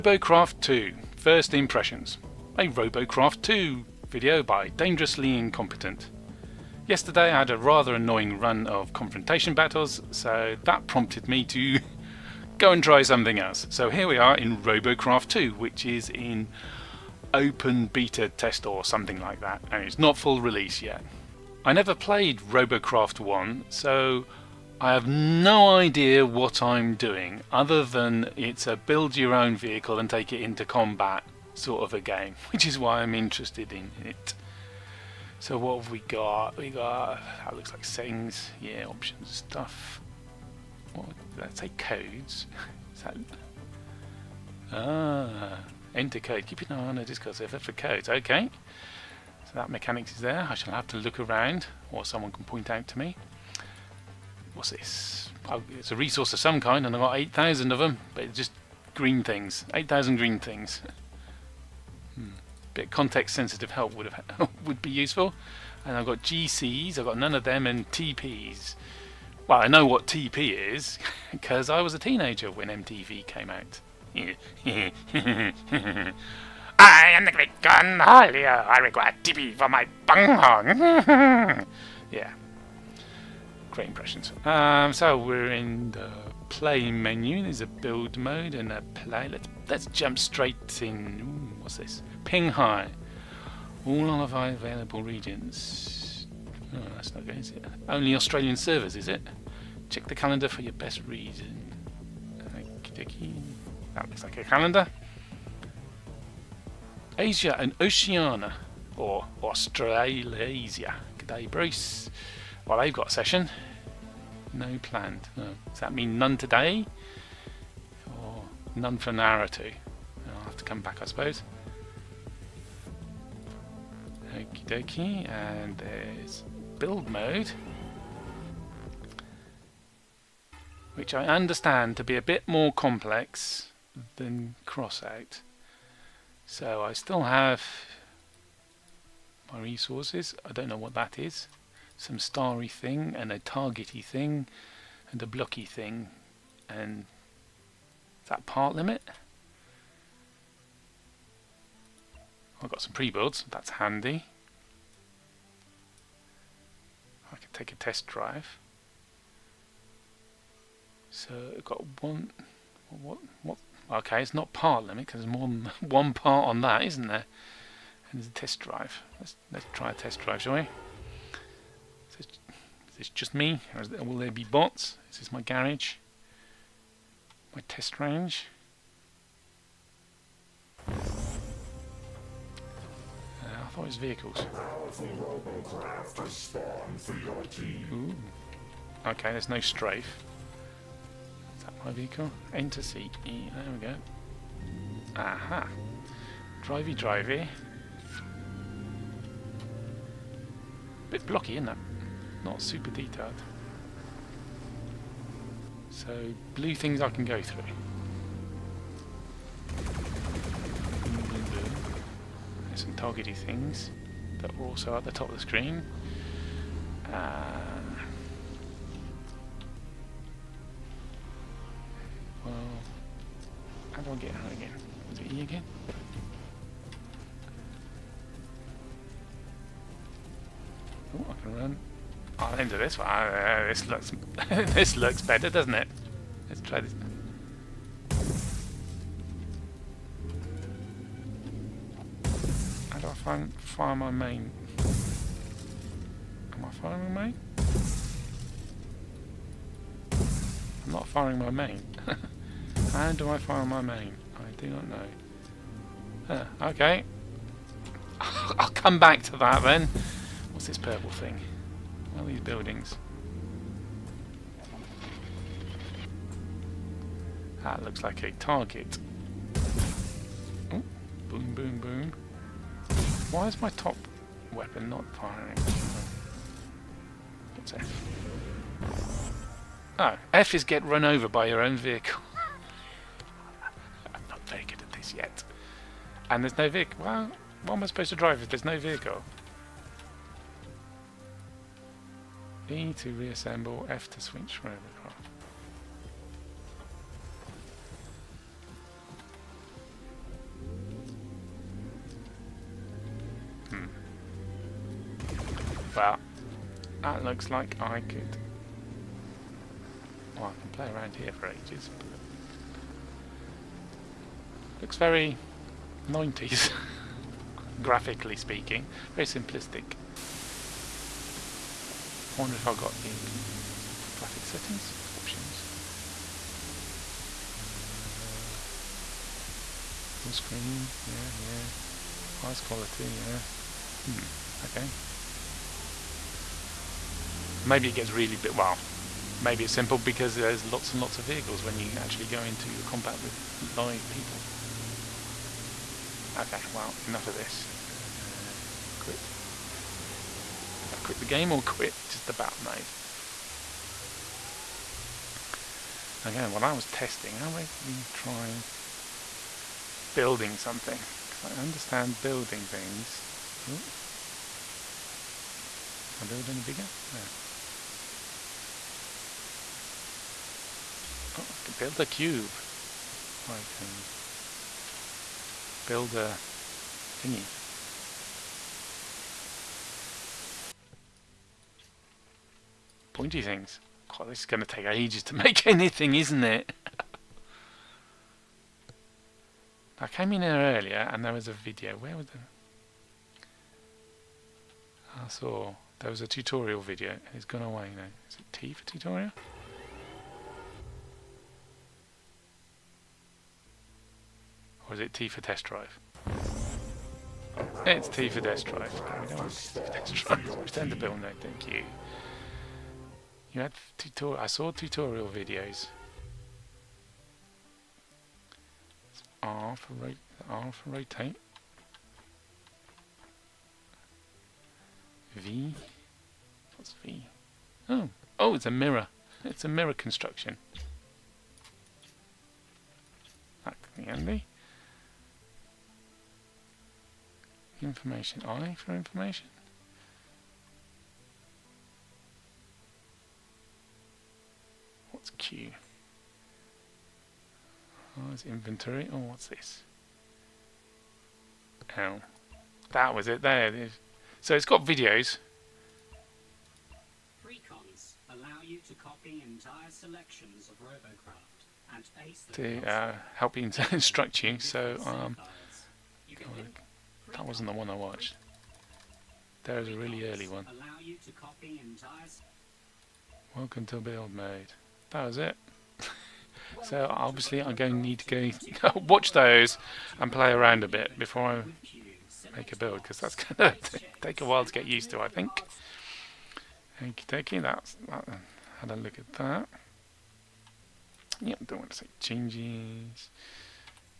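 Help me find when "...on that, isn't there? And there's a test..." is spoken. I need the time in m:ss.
2:46.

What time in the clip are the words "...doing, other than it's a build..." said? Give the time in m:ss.
0:26.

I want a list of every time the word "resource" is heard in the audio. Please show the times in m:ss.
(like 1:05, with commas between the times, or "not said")
0:55, 2:19.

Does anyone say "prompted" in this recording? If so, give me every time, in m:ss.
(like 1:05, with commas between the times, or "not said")
0:10.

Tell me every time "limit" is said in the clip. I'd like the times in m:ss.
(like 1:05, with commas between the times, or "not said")
2:28, 2:44.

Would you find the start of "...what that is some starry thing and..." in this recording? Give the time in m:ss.
2:20.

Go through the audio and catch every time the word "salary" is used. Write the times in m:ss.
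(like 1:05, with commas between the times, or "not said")
not said.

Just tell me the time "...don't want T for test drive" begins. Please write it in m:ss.
6:49.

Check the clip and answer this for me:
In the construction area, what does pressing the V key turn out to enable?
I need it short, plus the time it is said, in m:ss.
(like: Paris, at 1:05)
mirror construction, at 7:09.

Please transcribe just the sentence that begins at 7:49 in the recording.
There is a really early one.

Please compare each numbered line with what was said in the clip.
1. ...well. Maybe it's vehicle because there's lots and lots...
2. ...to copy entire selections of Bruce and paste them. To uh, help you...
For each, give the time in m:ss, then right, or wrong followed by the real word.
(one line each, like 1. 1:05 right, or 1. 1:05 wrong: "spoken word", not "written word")
1. 5:38 wrong: "simple", not "vehicle"
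2. 7:38 wrong: "Robocraft", not "Bruce".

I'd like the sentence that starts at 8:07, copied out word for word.
Okie dokie, that's, that, had a look at that.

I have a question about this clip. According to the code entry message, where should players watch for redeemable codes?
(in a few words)
Discord server.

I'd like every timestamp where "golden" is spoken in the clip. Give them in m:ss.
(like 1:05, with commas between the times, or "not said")
not said.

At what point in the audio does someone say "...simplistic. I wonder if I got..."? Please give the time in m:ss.
5:19.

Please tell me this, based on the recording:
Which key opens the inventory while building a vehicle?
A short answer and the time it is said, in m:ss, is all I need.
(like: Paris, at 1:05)
Q, at 7:25.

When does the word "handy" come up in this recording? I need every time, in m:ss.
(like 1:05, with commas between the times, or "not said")
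2:33, 7:14.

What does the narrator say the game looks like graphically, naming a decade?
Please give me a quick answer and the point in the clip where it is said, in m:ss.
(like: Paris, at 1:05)
90s, at 5:16.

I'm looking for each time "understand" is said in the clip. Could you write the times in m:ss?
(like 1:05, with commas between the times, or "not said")
2:11, 6:01.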